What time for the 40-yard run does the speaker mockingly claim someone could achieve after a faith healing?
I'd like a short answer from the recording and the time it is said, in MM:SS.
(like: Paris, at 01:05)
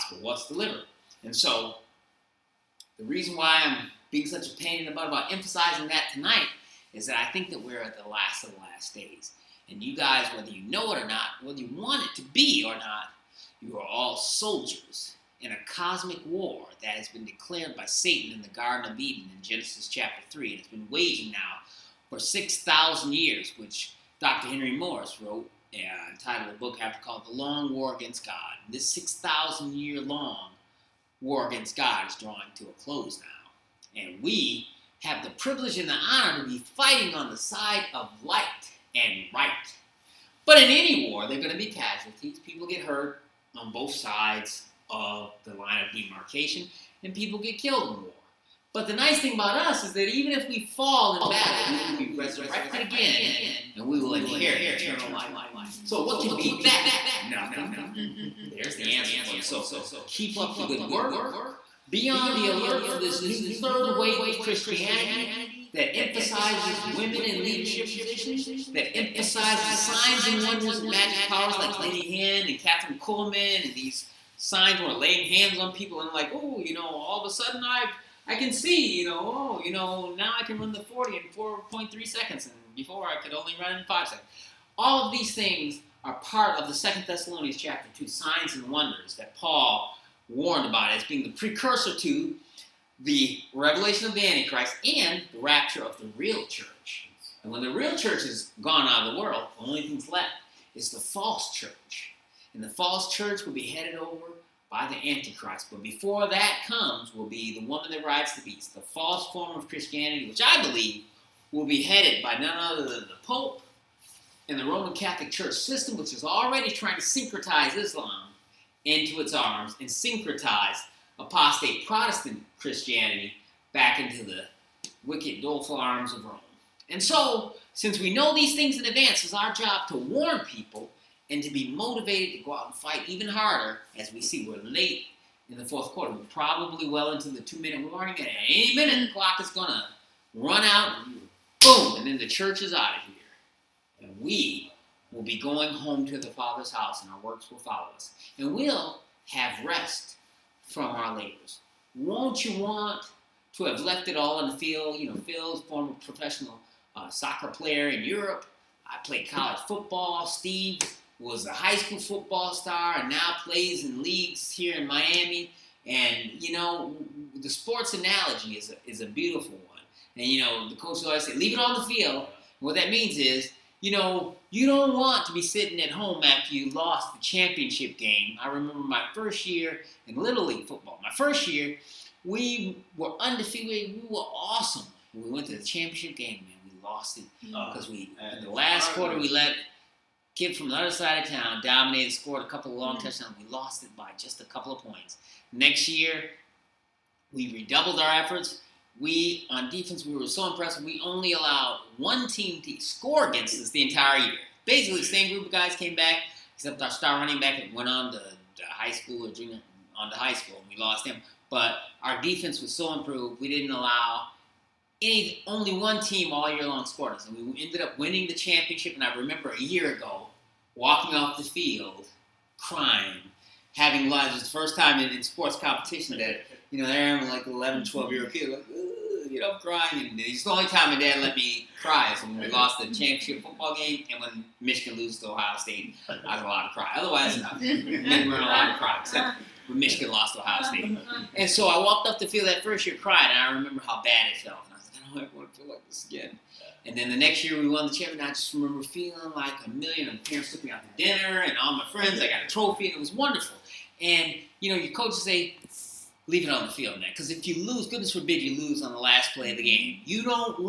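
4.3 seconds, at 01:21.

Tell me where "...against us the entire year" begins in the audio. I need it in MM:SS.
03:23.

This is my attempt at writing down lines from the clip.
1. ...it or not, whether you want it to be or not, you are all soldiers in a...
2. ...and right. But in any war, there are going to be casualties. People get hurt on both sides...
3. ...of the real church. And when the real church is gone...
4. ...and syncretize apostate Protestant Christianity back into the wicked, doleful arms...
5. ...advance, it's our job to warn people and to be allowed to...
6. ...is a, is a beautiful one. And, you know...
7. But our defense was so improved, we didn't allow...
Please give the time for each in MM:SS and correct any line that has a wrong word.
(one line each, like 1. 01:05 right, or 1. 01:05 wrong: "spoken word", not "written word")
1. 00:10 right
2. 00:38 right
3. 01:35 right
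4. 01:59 right
5. 02:08 wrong: "motivated", not "allowed"
6. 02:48 right
7. 03:31 right.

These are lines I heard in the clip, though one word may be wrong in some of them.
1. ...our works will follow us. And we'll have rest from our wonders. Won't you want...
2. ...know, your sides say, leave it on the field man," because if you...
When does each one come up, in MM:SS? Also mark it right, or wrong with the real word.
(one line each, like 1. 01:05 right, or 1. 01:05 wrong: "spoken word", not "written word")
1. 02:27 wrong: "labors", not "wonders"
2. 04:14 wrong: "coaches", not "sides".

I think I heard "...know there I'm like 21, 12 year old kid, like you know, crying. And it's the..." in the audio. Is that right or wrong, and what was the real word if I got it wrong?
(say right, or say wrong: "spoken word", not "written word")
wrong: "11", not "21".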